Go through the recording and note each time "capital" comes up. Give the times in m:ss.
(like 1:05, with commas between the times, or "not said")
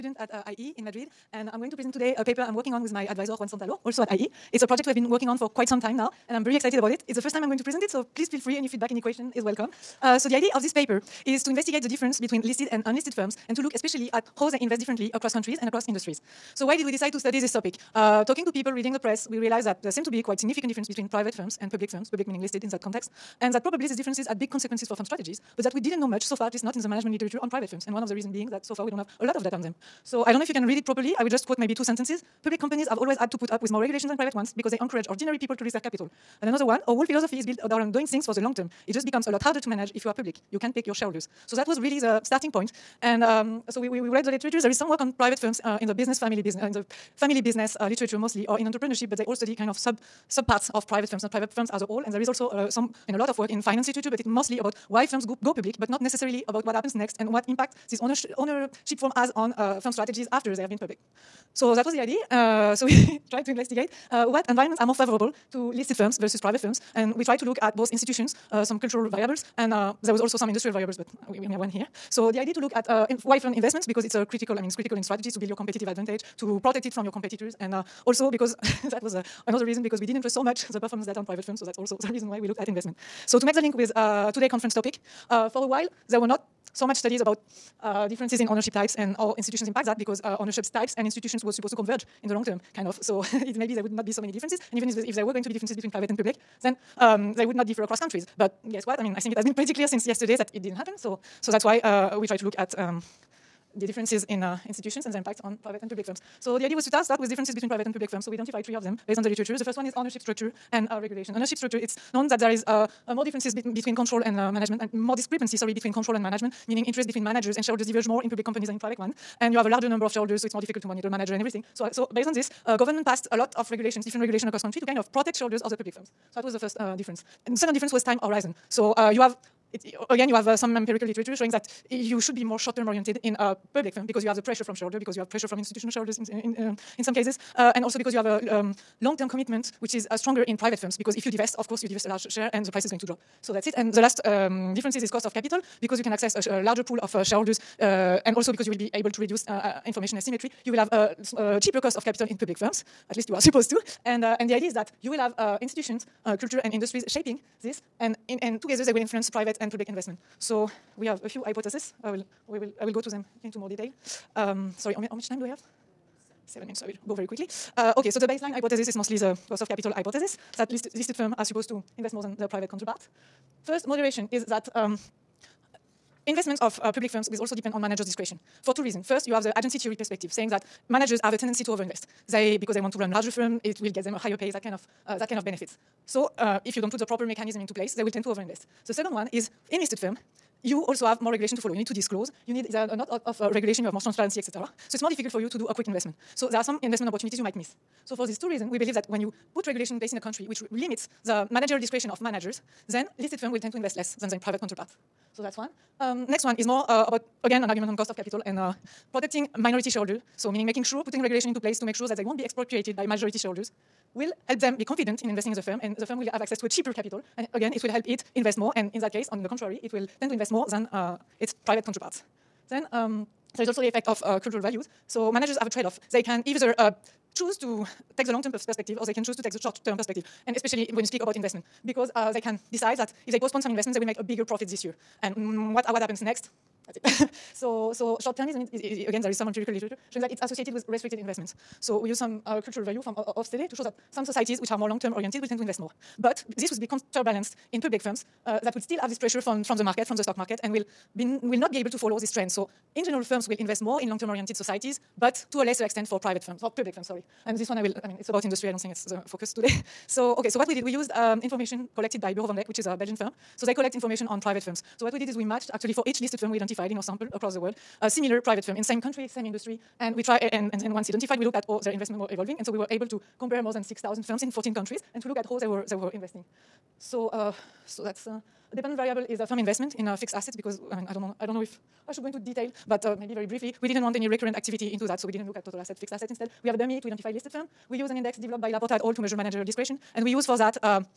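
0:35, 2:25, 2:32, 2:49, 3:28, 3:36.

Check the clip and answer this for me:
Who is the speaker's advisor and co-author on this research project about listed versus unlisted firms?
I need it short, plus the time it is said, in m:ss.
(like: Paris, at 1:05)
Juan Santalo, at 0:03.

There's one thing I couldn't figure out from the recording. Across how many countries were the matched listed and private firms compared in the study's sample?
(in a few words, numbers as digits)
14.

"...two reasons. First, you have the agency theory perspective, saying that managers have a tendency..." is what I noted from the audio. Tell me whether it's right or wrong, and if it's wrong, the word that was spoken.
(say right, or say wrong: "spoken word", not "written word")
right.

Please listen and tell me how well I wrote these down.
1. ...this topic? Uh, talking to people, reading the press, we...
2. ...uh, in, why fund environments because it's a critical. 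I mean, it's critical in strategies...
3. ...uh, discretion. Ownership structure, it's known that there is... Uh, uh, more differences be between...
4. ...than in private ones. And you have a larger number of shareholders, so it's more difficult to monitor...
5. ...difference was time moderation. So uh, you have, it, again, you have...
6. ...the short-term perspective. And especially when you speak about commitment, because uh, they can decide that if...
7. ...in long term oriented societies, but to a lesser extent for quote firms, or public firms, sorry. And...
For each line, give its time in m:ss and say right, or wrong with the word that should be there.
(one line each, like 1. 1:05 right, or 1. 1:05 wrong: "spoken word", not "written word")
1. 0:17 right
2. 1:12 wrong: "investments", not "environments"
3. 1:50 wrong: "regulation", not "discretion"
4. 1:58 right
5. 2:07 wrong: "horizon", not "moderation"
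6. 3:49 wrong: "investment", not "commitment"
7. 4:13 wrong: "private", not "quote".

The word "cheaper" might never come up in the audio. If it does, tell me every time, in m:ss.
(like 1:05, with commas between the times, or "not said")
2:31, 3:36.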